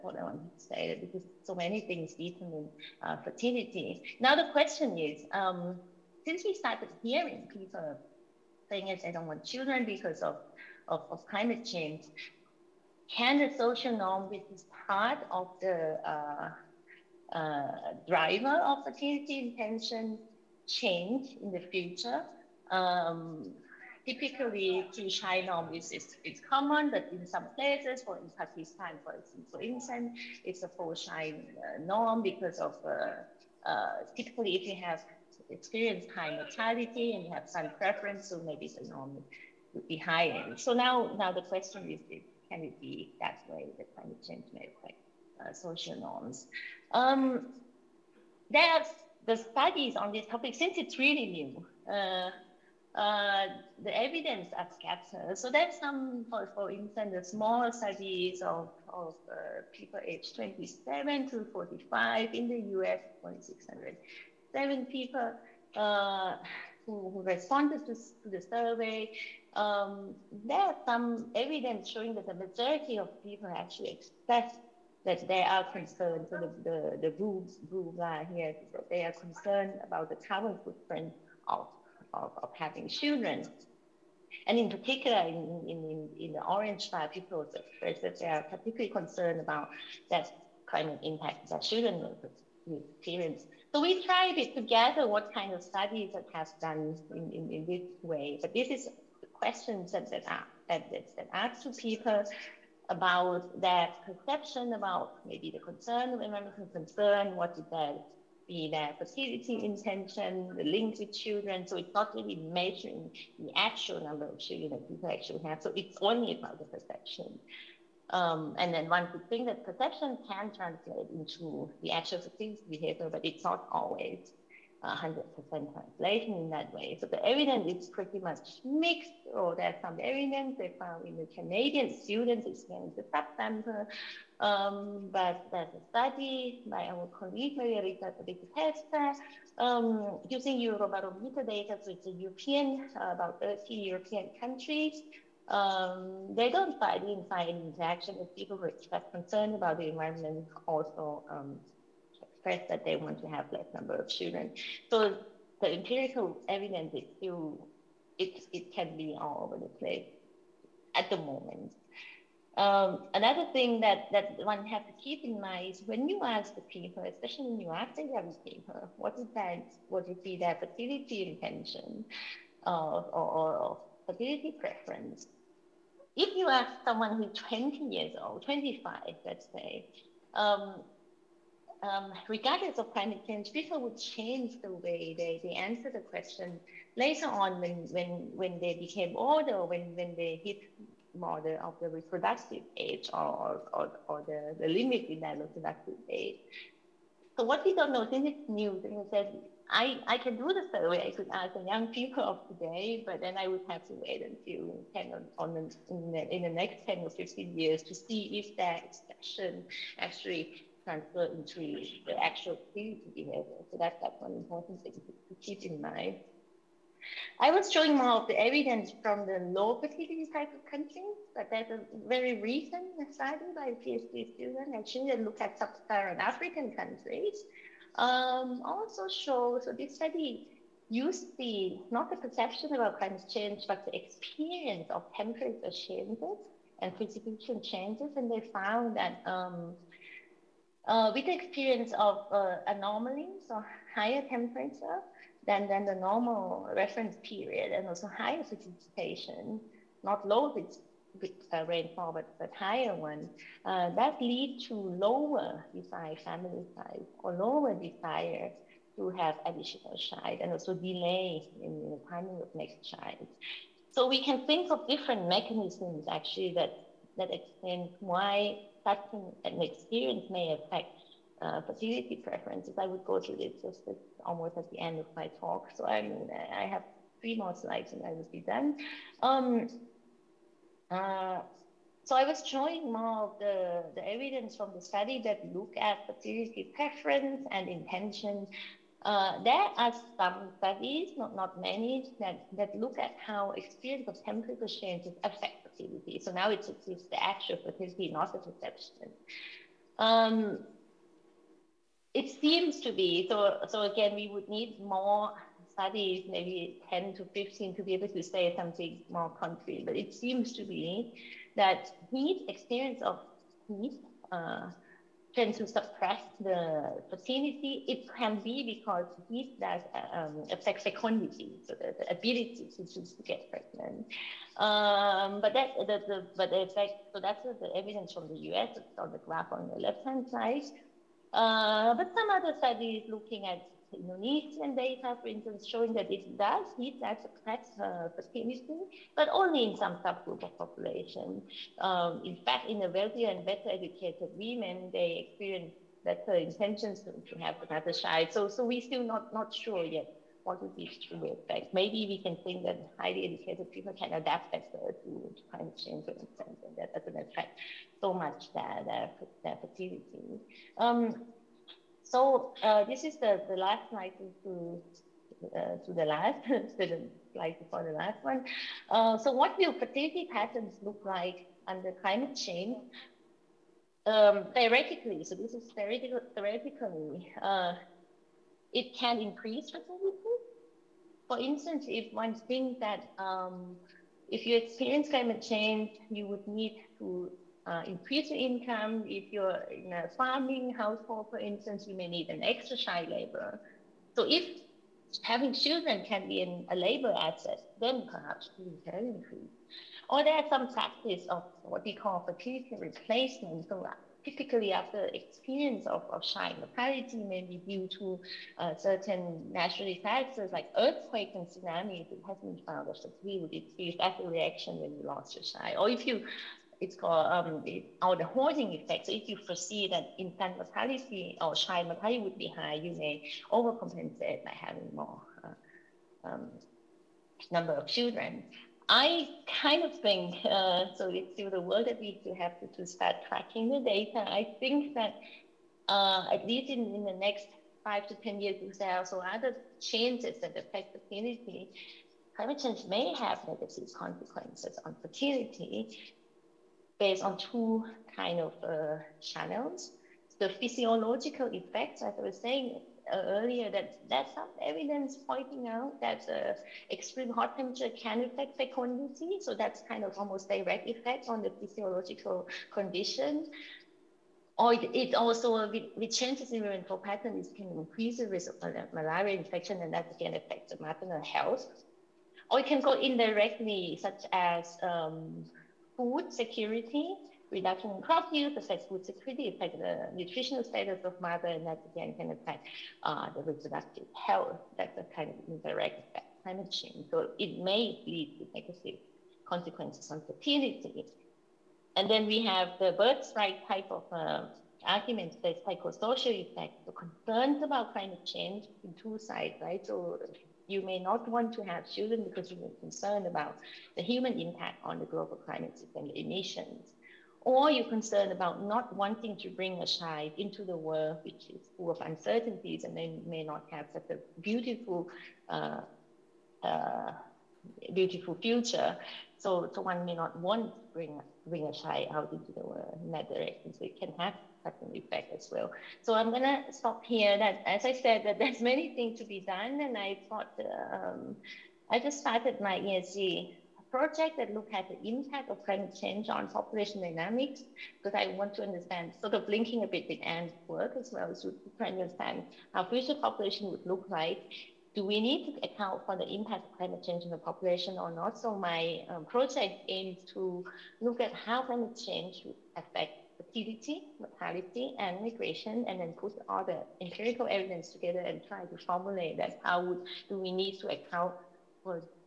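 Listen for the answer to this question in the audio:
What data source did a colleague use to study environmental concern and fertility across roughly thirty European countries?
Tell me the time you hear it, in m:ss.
2:20.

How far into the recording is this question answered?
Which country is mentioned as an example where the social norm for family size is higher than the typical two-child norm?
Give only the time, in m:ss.
0:28.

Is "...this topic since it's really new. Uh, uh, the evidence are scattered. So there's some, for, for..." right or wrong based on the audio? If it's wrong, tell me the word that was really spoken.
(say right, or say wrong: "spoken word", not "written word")
right.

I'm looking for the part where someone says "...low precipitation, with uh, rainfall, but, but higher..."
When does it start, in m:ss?
4:10.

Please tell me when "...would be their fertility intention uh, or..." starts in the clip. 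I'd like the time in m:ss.
2:50.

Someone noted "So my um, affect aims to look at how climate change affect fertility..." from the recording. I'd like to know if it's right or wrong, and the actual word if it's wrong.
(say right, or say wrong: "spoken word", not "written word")
wrong: "project", not "affect".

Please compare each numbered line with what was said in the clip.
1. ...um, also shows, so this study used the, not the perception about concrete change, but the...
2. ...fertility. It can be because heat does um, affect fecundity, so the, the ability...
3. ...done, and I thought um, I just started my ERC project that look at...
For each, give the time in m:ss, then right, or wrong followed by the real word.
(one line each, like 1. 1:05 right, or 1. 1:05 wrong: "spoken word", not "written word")
1. 3:47 wrong: "climate", not "concrete"
2. 5:17 right
3. 8:49 right.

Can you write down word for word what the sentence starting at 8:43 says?
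So it can have such an effect as well.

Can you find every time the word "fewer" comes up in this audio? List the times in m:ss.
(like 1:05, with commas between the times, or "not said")
not said.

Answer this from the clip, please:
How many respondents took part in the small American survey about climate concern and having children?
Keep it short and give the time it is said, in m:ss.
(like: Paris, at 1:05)
607, at 1:03.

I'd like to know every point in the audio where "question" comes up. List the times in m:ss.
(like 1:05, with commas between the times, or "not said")
0:04, 0:41, 1:39, 3:06.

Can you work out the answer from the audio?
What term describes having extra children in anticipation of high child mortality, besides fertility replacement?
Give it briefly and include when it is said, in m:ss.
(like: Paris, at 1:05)
Hoarding effect, at 6:58.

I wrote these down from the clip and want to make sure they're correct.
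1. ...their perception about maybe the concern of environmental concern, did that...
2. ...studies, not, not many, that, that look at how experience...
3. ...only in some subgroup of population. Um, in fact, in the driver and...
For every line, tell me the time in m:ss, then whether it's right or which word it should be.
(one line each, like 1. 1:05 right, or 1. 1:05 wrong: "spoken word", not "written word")
1. 1:43 right
2. 4:50 right
3. 5:39 wrong: "wealthier", not "driver".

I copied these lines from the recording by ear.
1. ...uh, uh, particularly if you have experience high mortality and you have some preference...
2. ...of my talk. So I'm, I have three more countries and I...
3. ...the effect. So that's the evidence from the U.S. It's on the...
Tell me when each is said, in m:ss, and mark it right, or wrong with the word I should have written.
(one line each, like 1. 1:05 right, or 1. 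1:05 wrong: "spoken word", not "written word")
1. 0:32 wrong: "typically", not "particularly"
2. 4:35 wrong: "slides", not "countries"
3. 5:26 right.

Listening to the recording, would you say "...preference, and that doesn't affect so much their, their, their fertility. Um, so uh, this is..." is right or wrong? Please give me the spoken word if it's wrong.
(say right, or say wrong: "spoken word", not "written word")
wrong: "instance", not "preference".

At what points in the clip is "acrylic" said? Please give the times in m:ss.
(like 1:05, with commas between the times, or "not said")
not said.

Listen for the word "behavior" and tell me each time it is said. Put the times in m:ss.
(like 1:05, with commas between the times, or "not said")
2:02, 3:33.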